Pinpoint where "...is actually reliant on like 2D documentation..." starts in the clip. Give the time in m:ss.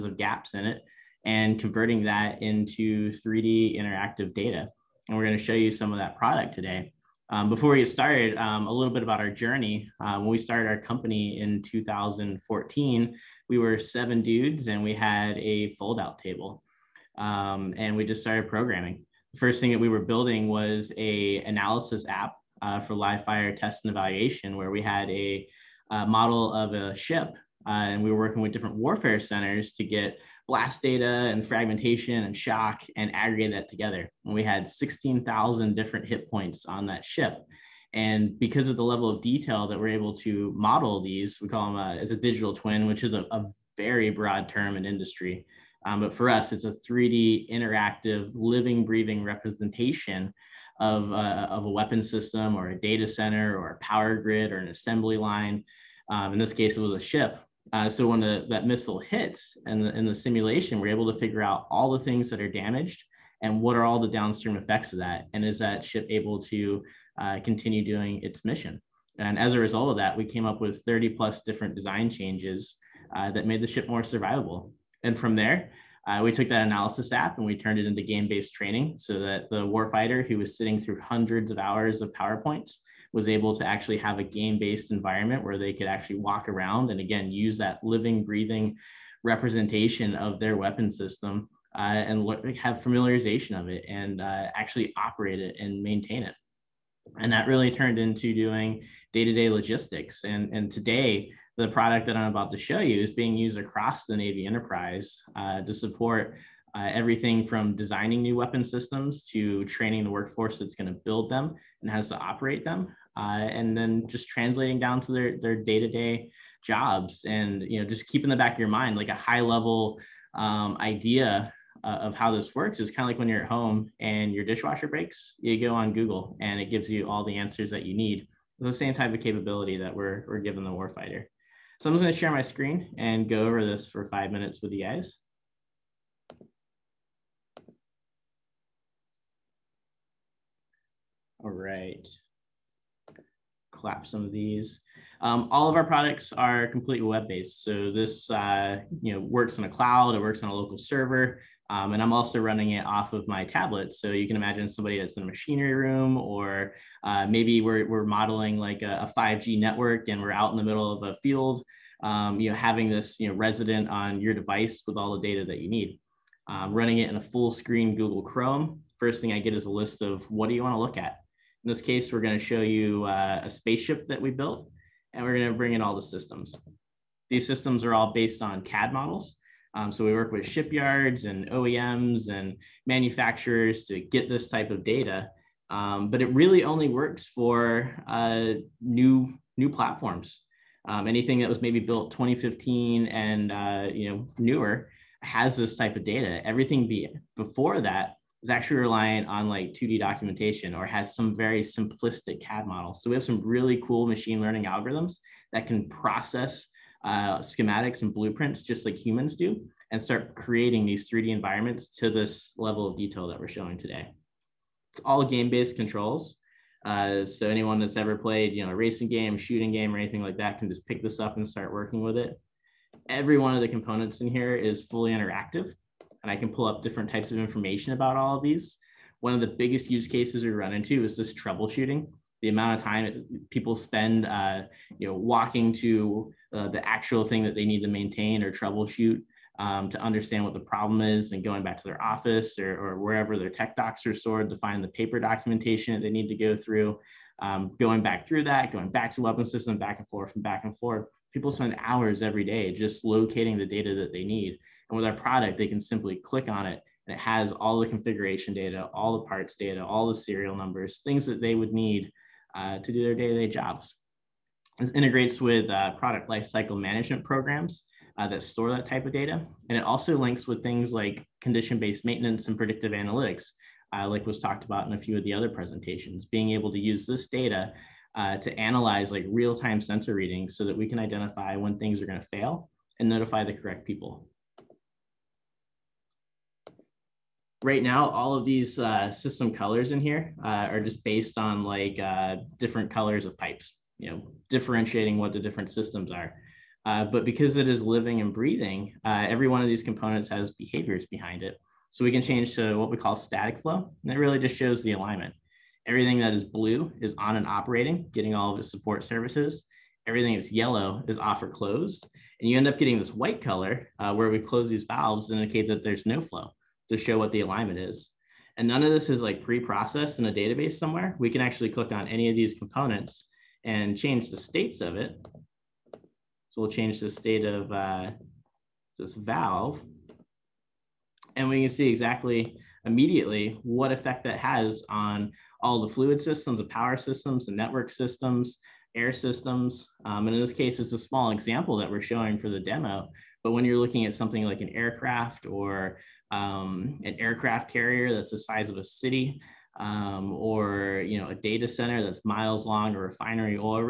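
3:18.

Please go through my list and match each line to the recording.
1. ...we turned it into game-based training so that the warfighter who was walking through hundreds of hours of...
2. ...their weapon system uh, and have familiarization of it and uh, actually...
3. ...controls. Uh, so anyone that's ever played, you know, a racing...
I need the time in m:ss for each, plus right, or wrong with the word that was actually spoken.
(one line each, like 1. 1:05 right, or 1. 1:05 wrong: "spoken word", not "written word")
1. 1:17 wrong: "sitting", not "walking"
2. 1:30 right
3. 3:35 right.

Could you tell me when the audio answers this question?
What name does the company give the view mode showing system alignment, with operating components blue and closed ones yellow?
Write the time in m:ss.
5:03.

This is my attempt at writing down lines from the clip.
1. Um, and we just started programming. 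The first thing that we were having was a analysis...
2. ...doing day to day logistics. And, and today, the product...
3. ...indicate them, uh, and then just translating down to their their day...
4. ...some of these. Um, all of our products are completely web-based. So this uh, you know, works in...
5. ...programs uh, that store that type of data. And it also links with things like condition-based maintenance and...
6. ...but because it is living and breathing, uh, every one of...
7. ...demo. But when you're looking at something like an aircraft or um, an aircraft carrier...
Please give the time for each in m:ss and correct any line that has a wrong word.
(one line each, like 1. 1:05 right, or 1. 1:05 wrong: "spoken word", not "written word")
1. 0:17 wrong: "building", not "having"
2. 1:38 right
3. 1:52 wrong: "operate", not "indicate"
4. 2:24 right
5. 4:27 right
6. 4:57 right
7. 5:42 right.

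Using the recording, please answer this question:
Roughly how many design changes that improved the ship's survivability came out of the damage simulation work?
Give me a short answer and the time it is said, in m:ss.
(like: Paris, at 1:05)
30 plus, at 1:10.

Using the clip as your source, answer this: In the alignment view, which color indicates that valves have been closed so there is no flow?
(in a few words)
white.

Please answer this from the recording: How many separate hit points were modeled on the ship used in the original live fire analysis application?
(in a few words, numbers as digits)
16,000.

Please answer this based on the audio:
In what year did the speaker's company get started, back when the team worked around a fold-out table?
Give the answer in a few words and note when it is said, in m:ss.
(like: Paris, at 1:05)
2014, at 0:11.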